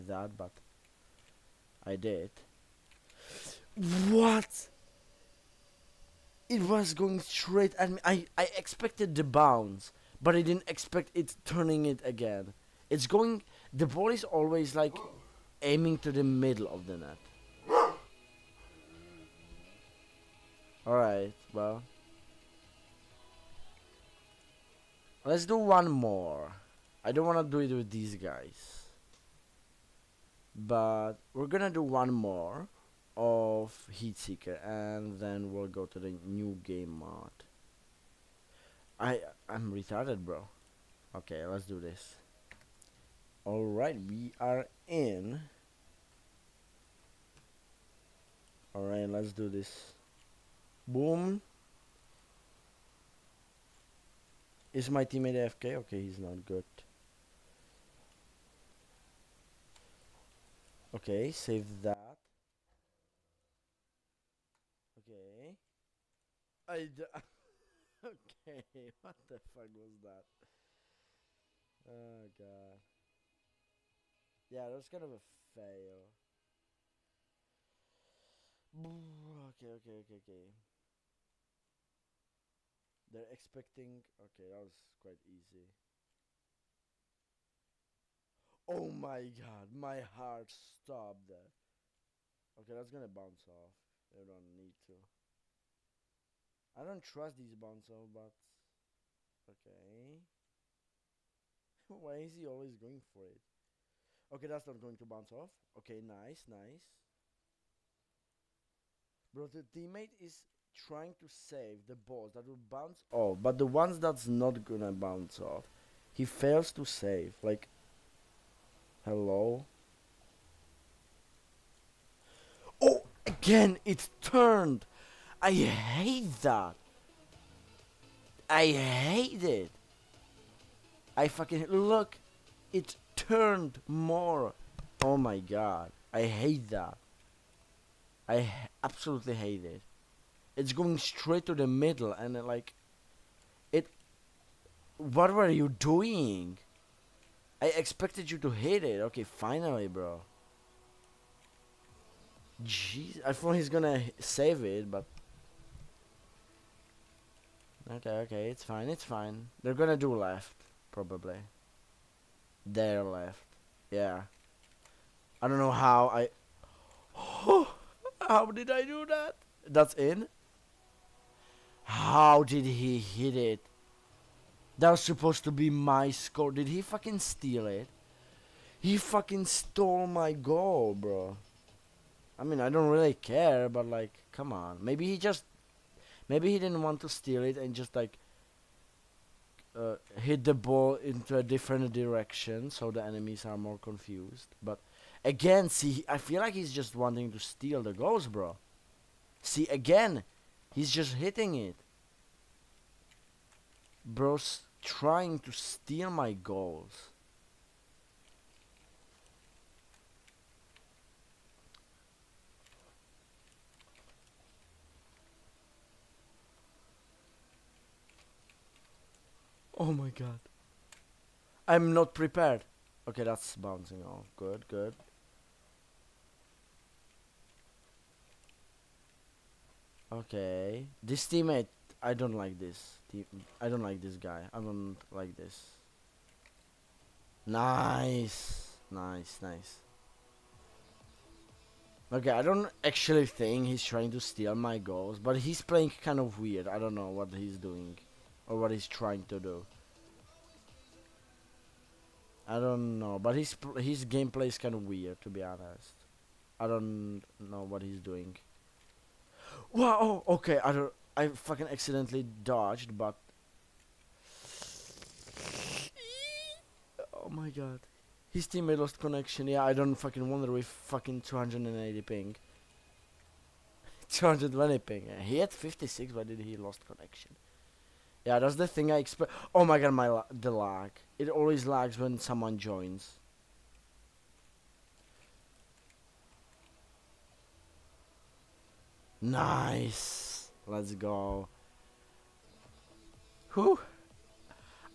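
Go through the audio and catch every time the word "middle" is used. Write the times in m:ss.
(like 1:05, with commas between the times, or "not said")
0:16, 2:21.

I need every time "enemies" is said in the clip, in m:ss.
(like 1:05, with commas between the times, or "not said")
3:13.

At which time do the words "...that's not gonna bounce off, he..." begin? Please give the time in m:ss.
1:53.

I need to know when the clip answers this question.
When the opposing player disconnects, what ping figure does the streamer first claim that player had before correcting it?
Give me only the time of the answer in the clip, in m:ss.
4:31.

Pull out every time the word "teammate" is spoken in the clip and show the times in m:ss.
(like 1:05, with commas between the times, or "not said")
0:55, 1:49, 3:51, 4:28.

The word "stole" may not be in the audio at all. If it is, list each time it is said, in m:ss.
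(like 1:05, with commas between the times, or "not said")
2:59.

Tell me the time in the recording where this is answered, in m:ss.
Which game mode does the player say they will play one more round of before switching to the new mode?
0:33.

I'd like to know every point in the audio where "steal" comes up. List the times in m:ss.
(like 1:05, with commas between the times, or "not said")
2:57, 3:07, 3:17, 3:25, 4:04.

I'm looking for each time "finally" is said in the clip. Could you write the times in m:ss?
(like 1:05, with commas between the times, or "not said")
2:29.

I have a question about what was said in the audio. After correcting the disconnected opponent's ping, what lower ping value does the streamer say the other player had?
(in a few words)
56.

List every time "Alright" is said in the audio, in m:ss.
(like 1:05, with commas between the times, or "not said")
0:20, 0:43, 0:48.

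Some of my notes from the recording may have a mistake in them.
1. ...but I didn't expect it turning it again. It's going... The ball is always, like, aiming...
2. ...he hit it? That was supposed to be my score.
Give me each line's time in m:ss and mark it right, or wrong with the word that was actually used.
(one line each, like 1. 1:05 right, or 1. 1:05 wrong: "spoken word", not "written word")
1. 0:10 right
2. 2:52 right.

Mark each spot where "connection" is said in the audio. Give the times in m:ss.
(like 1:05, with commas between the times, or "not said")
4:28, 4:36.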